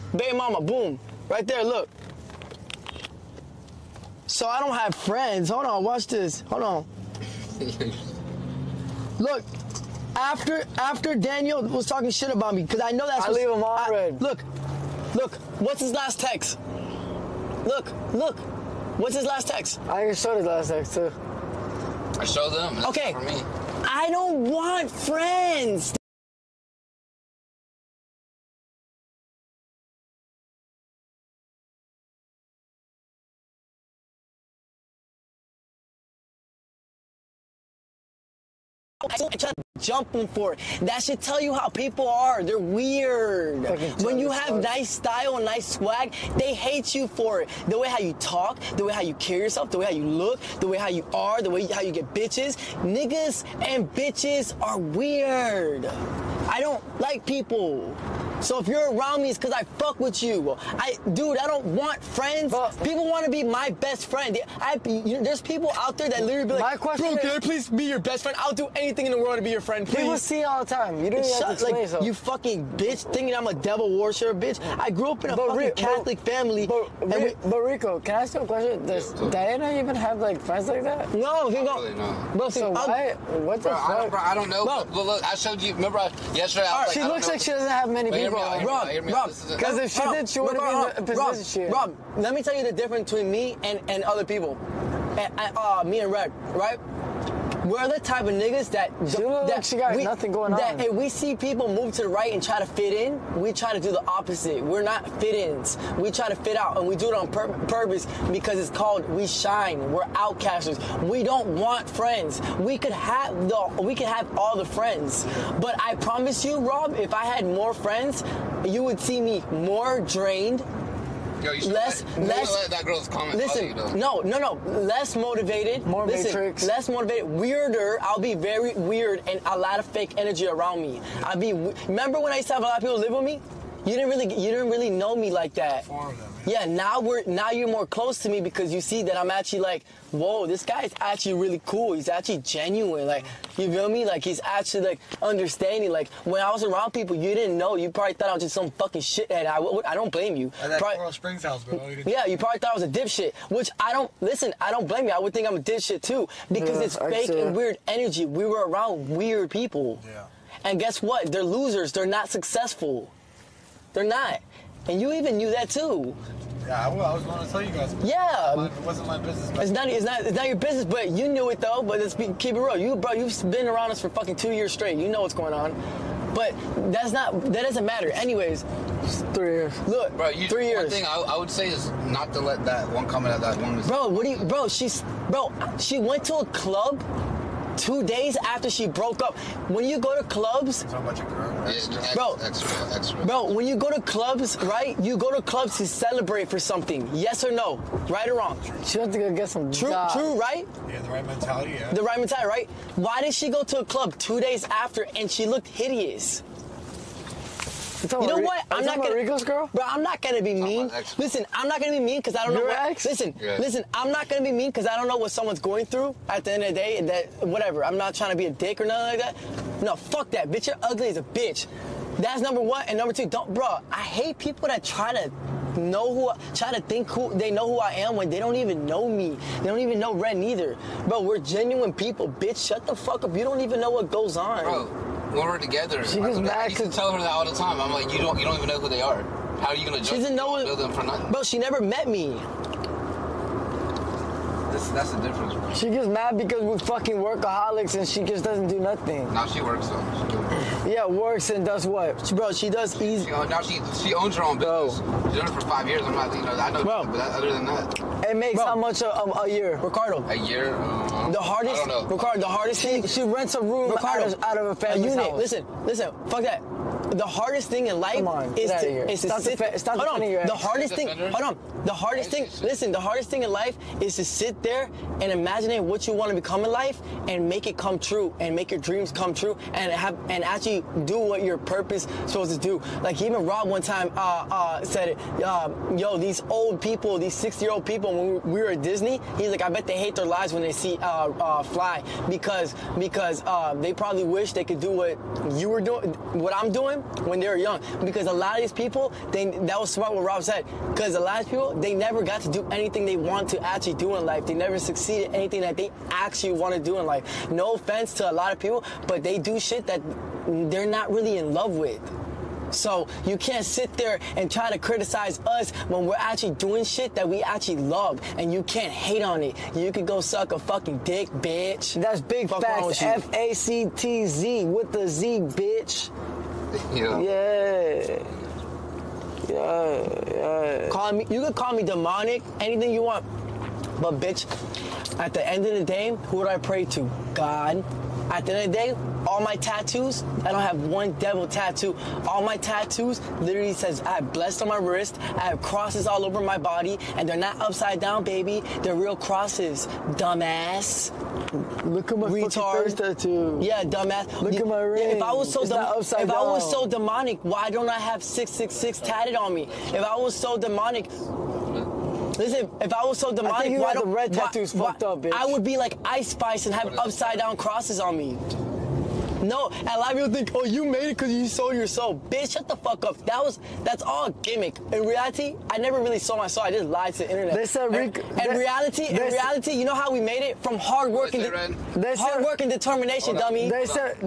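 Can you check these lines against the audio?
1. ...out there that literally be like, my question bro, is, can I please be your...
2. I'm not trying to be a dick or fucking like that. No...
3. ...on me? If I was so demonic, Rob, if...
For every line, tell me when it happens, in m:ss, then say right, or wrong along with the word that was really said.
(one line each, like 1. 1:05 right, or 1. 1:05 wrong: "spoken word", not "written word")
1. 1:05 right
2. 3:37 wrong: "nothing", not "fucking"
3. 5:59 wrong: "Listen", not "Rob".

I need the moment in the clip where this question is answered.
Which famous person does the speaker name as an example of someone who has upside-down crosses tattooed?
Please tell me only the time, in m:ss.
6:06.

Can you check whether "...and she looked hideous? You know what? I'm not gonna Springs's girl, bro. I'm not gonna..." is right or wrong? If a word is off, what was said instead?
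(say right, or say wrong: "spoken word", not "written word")
wrong: "Rico", not "Springs".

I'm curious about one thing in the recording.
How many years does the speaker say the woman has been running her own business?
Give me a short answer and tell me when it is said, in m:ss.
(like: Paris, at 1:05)
5, at 4:15.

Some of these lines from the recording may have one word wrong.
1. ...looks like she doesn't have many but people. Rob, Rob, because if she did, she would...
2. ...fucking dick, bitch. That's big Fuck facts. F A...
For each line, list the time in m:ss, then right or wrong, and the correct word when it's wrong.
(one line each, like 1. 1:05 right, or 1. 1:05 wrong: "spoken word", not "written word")
1. 1:27 right
2. 5:20 right.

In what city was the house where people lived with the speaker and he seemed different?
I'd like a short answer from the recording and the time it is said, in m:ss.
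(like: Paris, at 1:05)
Coral Springs, at 2:30.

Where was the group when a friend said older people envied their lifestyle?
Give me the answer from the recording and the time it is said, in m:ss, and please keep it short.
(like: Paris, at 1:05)
Disney, at 4:48.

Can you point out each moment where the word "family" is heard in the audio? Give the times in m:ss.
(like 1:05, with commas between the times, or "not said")
1:16, 4:24.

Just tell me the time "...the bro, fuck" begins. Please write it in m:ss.
1:23.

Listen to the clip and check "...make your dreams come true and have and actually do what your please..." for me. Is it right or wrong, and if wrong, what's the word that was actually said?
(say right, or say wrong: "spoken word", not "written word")
wrong: "purpose", not "please".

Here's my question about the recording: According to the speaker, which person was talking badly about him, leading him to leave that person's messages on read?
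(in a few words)
Daniel.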